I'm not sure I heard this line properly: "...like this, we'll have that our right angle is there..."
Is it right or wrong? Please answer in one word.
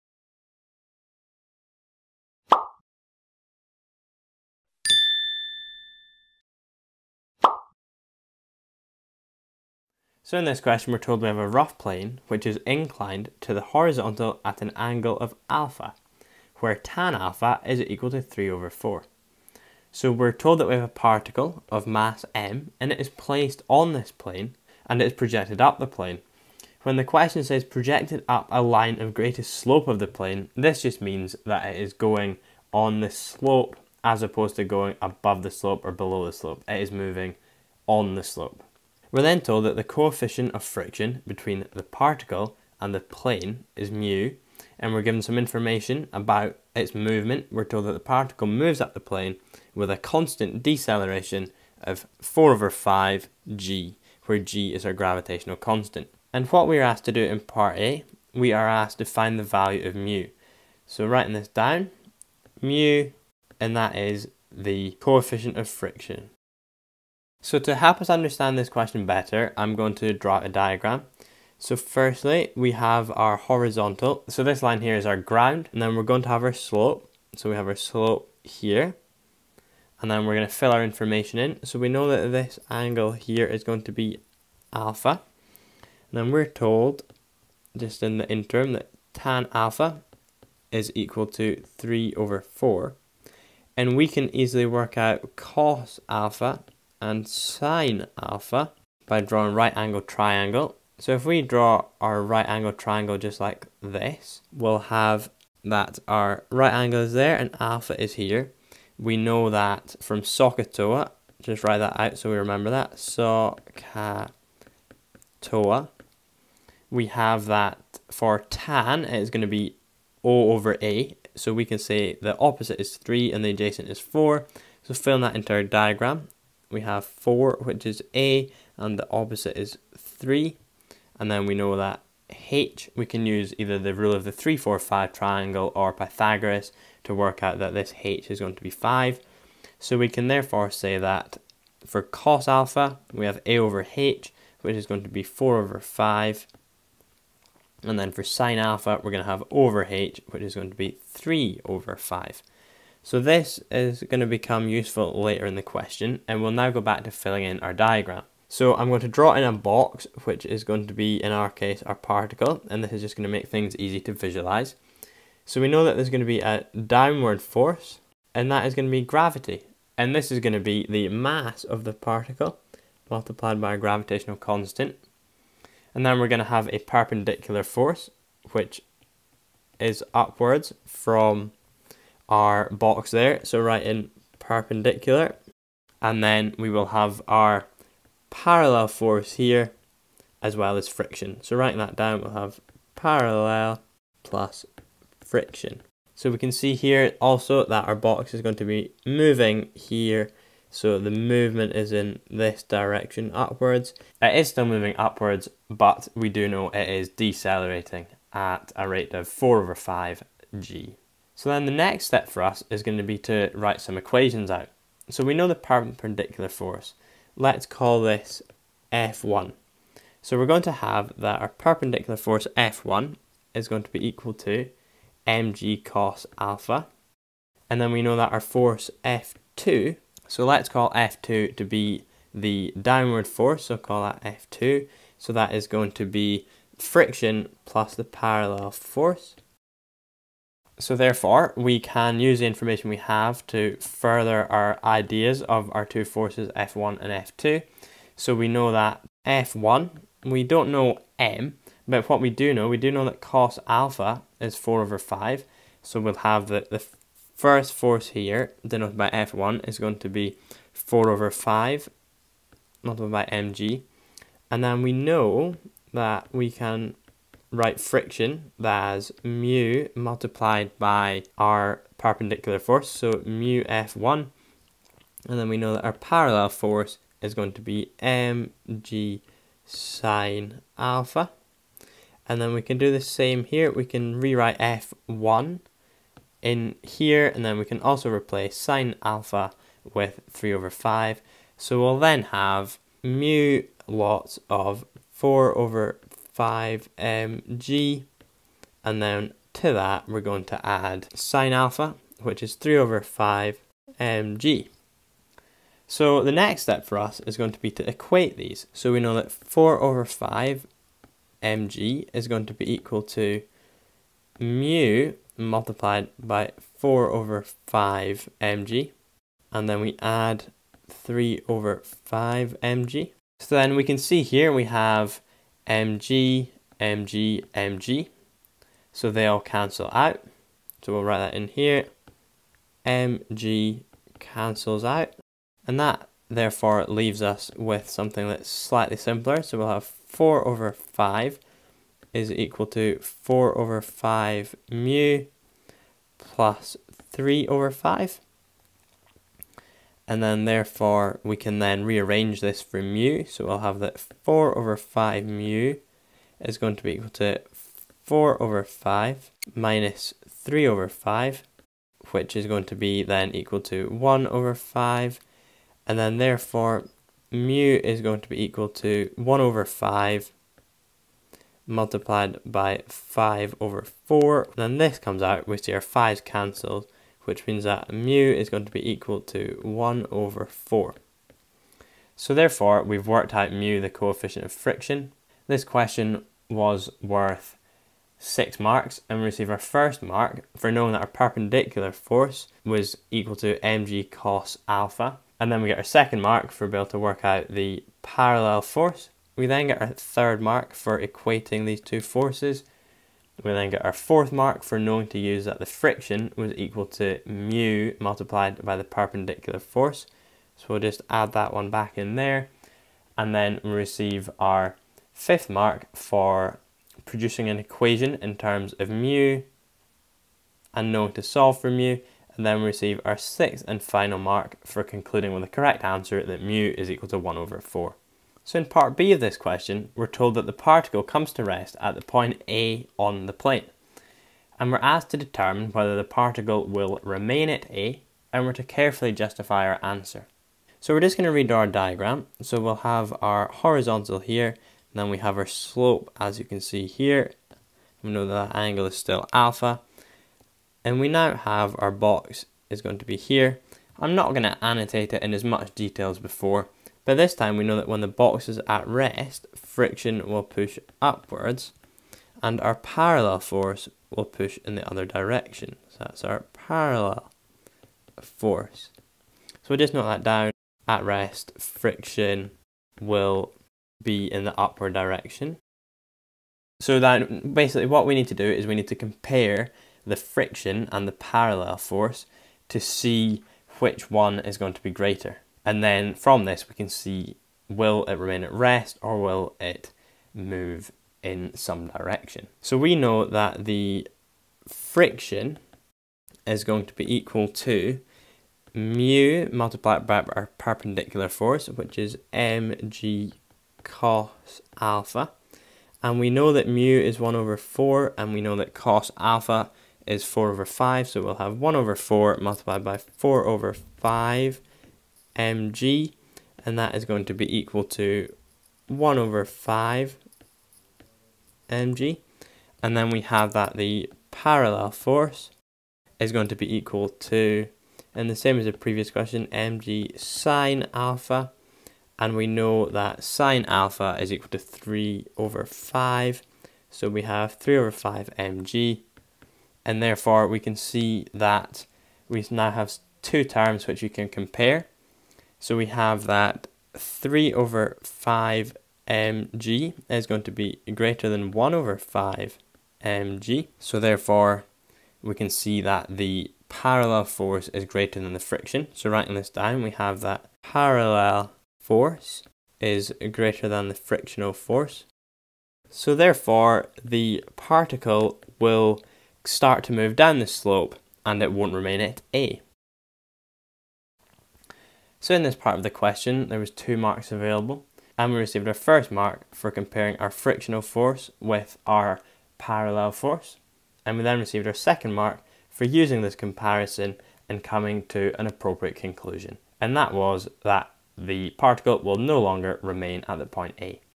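right.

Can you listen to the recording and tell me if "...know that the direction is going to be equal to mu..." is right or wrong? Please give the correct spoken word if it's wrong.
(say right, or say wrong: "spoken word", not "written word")
wrong: "friction", not "direction".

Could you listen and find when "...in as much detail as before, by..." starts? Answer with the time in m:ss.
7:35.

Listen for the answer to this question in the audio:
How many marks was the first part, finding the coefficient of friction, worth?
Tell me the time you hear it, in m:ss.
6:28.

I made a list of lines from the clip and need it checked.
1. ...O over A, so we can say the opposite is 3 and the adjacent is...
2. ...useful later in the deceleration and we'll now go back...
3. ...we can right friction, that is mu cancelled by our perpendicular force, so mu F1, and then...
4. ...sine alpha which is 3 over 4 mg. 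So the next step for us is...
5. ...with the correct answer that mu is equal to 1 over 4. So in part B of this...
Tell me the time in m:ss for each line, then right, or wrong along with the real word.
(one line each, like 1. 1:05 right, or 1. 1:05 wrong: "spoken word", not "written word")
1. 2:00 right
2. 2:34 wrong: "question", not "deceleration"
3. 4:26 wrong: "multiplied", not "cancelled"
4. 5:01 wrong: "5", not "4"
5. 7:05 right.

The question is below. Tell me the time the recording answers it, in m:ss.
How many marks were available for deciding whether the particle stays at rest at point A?
9:36.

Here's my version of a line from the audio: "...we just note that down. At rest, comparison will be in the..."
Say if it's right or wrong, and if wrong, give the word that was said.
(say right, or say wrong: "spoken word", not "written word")
wrong: "friction", not "comparison".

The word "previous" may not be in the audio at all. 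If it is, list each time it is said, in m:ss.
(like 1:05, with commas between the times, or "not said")
8:48.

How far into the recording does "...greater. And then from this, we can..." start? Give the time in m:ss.
8:04.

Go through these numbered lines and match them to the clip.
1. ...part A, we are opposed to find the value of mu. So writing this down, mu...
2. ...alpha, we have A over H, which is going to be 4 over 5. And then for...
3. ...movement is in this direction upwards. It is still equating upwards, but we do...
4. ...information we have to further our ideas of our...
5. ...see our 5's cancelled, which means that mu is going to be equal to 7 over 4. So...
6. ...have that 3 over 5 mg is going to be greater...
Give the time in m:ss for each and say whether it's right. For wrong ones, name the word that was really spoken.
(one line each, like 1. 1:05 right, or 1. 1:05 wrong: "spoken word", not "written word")
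1. 0:57 wrong: "asked", not "opposed"
2. 2:22 right
3. 3:21 wrong: "moving", not "equating"
4. 4:02 right
5. 6:15 wrong: "1", not "7"
6. 9:05 right.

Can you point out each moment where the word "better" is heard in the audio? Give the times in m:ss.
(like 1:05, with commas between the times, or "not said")
1:09.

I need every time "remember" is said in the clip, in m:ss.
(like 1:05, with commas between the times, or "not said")
1:52.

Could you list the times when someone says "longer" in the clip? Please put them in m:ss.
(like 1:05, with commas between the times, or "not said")
9:52.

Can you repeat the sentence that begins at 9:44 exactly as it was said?
And we then received our second mark for using this comparison and coming to an appropriate conclusion.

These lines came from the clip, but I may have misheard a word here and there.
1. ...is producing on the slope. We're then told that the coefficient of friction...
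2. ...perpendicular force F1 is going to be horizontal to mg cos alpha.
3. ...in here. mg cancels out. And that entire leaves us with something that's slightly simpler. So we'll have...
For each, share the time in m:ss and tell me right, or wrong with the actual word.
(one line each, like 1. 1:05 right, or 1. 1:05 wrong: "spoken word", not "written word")
1. 0:36 wrong: "moving", not "producing"
2. 3:41 wrong: "equal", not "horizontal"
3. 5:31 wrong: "therefore", not "entire".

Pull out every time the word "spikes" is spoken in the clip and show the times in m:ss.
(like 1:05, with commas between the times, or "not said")
not said.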